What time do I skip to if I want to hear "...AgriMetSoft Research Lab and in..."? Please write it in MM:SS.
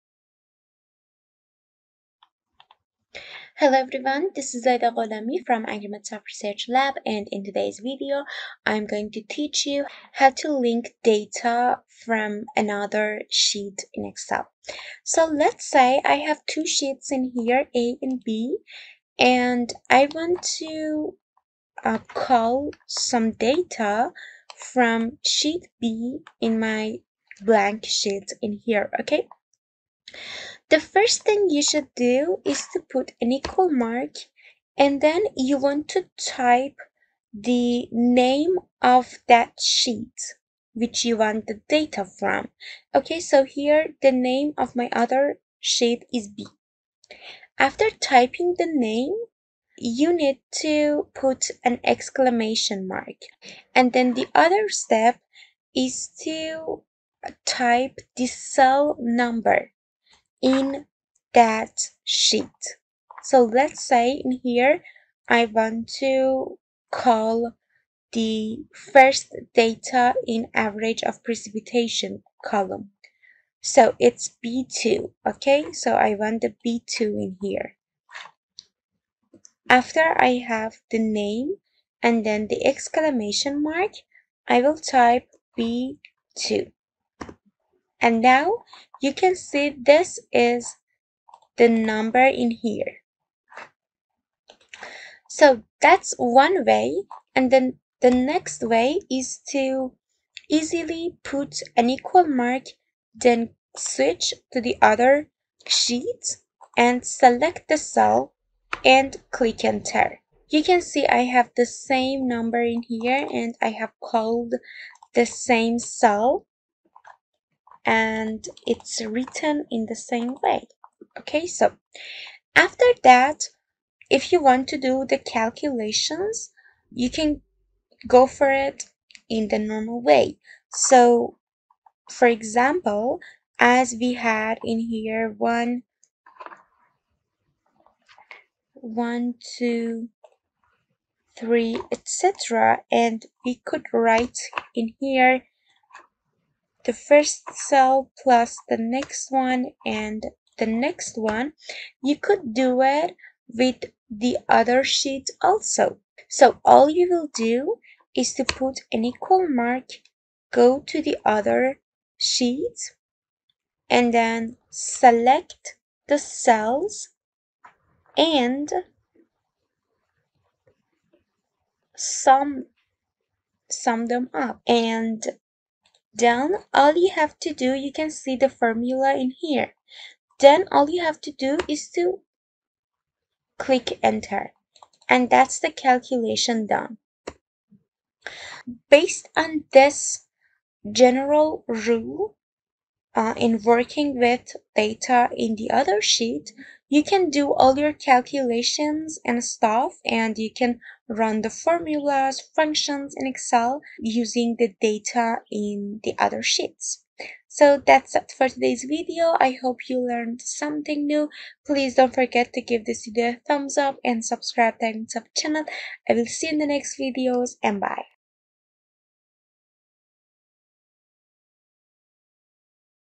00:05.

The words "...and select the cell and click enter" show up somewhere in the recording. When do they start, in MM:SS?
01:46.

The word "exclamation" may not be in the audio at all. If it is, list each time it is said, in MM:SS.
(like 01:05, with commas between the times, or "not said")
00:51, 01:22.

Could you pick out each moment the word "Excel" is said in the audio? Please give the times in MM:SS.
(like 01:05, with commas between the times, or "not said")
00:14, 03:23.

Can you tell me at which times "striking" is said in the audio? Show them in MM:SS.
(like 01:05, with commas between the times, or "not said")
not said.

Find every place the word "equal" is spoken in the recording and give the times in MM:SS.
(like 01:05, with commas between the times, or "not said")
00:33, 01:41, 02:39.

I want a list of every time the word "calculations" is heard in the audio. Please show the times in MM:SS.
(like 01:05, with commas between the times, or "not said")
02:05, 03:05, 03:17.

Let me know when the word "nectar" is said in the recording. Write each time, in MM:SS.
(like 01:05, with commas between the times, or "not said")
not said.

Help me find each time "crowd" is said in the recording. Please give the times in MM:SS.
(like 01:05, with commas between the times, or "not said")
not said.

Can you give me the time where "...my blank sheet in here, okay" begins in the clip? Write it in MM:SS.
00:26.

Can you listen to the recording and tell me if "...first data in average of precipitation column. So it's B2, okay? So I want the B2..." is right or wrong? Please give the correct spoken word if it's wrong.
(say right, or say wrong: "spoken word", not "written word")
right.